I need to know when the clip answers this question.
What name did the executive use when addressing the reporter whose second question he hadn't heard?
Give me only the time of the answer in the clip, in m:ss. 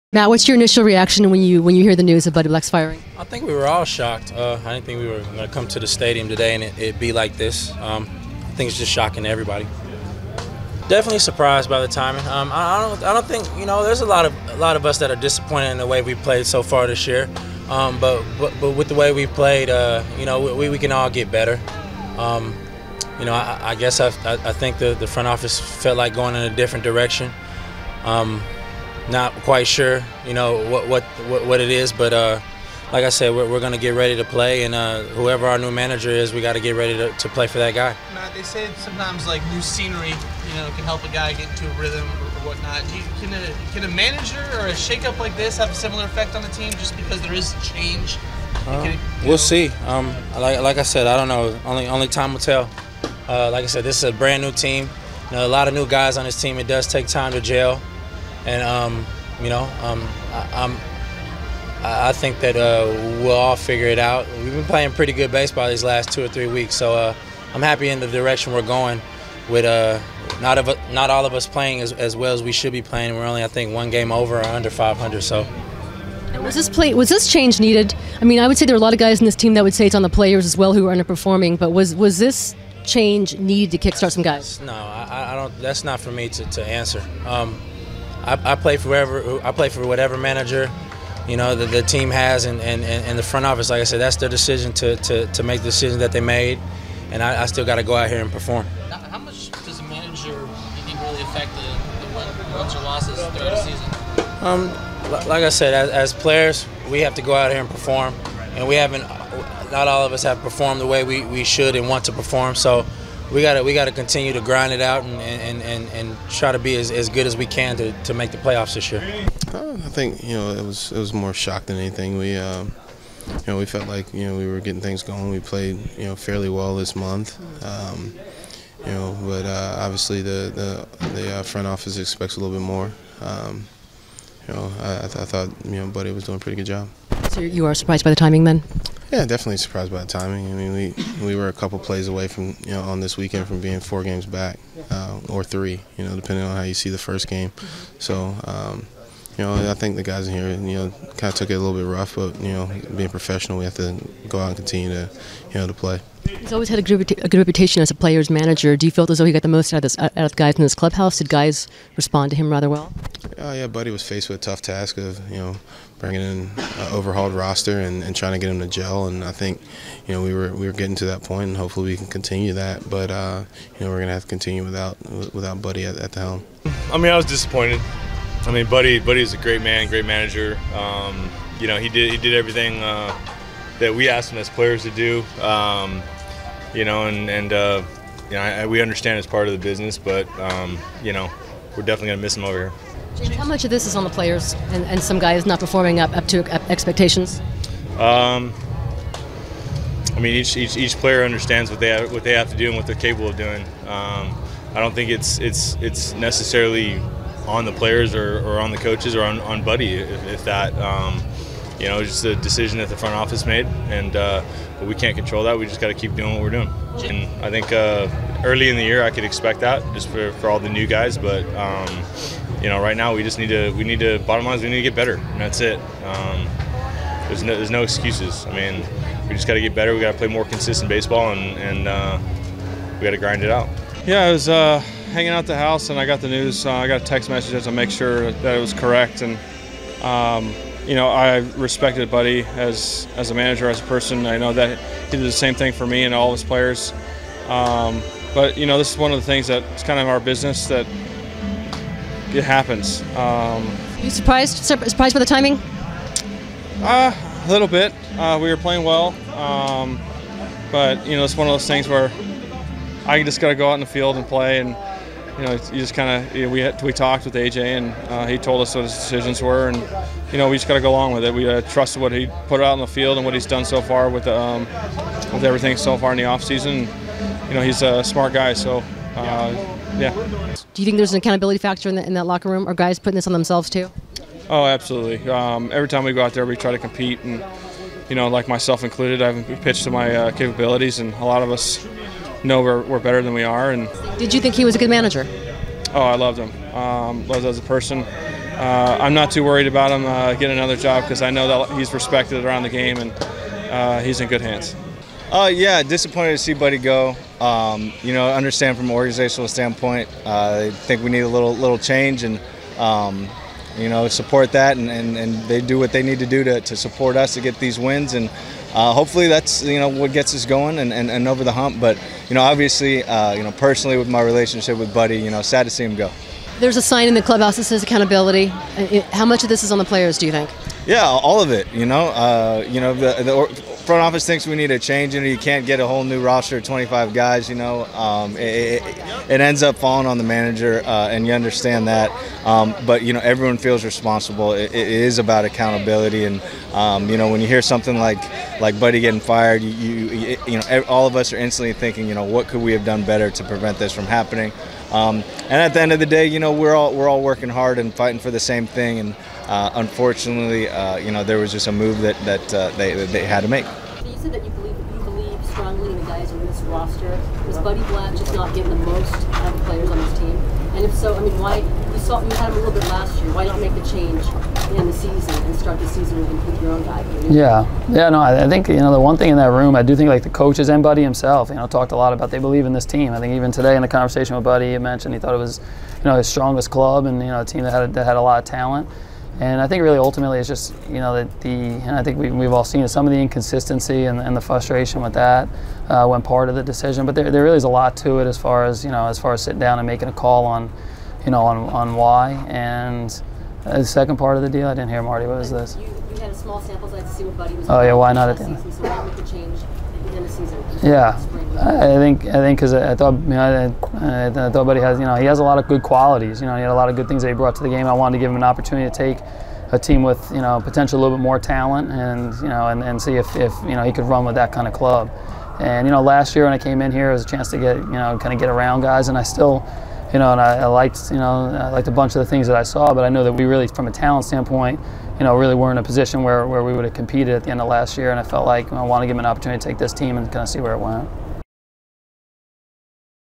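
6:45.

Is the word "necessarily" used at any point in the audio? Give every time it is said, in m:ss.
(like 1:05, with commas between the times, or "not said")
3:26.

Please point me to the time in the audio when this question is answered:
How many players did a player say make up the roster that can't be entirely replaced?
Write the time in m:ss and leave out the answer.
5:36.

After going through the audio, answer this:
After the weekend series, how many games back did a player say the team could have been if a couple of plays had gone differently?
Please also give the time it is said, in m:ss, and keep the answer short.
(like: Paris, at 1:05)
Four, at 2:23.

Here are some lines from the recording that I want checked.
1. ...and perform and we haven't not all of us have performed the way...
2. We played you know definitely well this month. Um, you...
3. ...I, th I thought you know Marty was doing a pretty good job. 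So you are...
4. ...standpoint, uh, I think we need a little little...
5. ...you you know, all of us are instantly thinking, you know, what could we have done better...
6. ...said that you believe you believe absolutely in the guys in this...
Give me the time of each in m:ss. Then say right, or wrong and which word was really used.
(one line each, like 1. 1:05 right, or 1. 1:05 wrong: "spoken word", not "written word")
1. 1:47 right
2. 2:05 wrong: "fairly", not "definitely"
3. 2:14 wrong: "Buddy", not "Marty"
4. 5:09 right
5. 5:50 right
6. 6:04 wrong: "strongly", not "absolutely".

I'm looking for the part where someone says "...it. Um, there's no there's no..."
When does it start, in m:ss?
3:45.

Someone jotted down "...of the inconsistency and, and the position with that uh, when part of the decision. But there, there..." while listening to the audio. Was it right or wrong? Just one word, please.
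wrong.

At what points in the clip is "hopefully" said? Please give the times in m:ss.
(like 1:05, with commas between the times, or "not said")
2:51, 5:18.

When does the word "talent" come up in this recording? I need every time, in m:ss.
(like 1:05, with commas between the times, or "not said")
6:28, 7:01, 7:13.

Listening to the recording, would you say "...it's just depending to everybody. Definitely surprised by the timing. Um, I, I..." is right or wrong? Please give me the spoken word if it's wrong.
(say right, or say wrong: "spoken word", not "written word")
wrong: "shocking", not "depending".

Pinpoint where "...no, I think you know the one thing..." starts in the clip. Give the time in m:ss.
6:18.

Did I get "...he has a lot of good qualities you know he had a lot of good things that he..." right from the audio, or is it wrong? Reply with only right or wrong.
right.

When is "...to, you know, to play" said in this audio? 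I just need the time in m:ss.
2:34.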